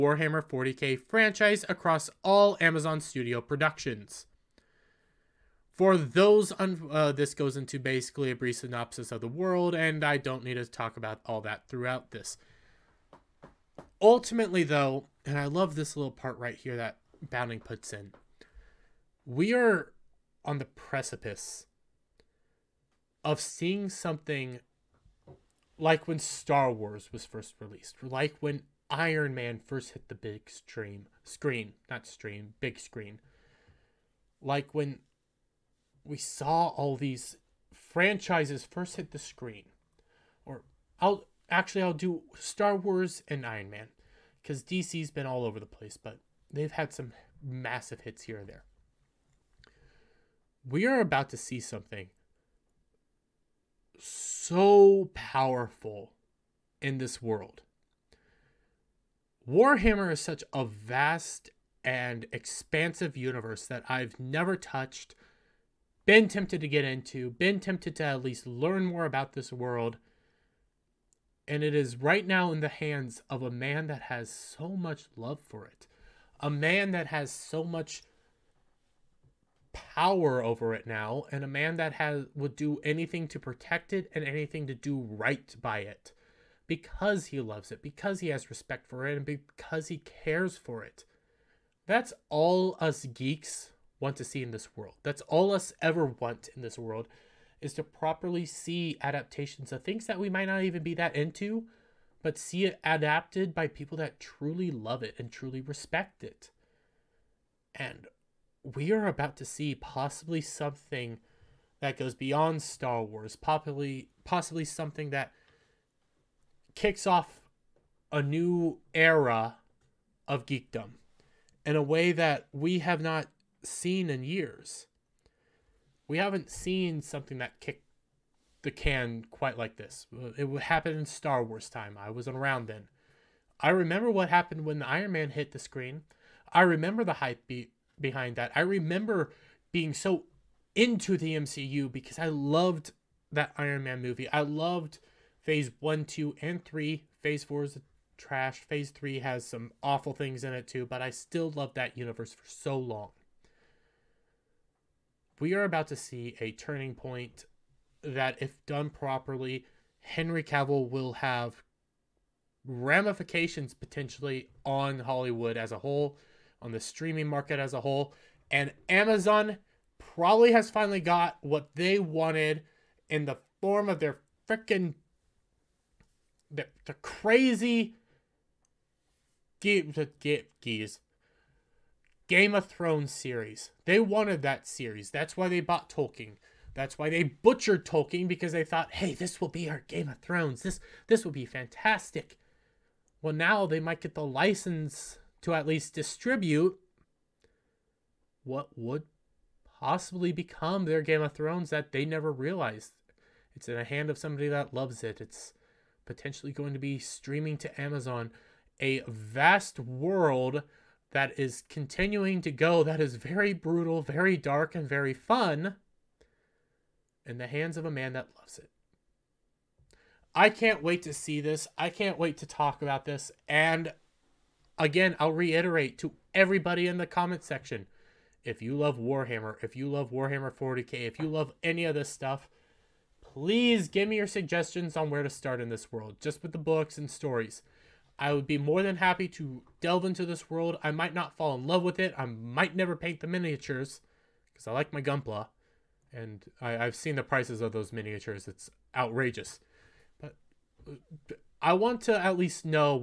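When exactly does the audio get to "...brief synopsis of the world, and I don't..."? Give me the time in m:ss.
0:08.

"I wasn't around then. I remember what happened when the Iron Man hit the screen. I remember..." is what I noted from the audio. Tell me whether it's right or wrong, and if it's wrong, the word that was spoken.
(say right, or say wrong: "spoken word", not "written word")
right.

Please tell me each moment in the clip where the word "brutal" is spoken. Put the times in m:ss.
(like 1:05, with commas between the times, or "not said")
3:33.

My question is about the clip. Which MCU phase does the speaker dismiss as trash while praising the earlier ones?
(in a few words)
Phase four.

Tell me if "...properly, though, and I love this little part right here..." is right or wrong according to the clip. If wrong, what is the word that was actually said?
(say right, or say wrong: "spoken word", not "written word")
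wrong: "ultimately", not "properly".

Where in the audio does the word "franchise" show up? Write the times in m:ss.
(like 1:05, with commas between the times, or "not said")
0:01, 0:37.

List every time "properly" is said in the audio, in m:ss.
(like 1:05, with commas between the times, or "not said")
1:37, 2:38.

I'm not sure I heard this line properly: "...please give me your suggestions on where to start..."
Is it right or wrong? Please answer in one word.
right.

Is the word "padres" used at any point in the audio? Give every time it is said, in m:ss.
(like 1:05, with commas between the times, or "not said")
not said.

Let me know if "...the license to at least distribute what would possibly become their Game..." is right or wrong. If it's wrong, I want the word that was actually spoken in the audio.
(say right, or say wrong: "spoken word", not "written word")
right.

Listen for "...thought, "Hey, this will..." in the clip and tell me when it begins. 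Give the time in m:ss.
3:08.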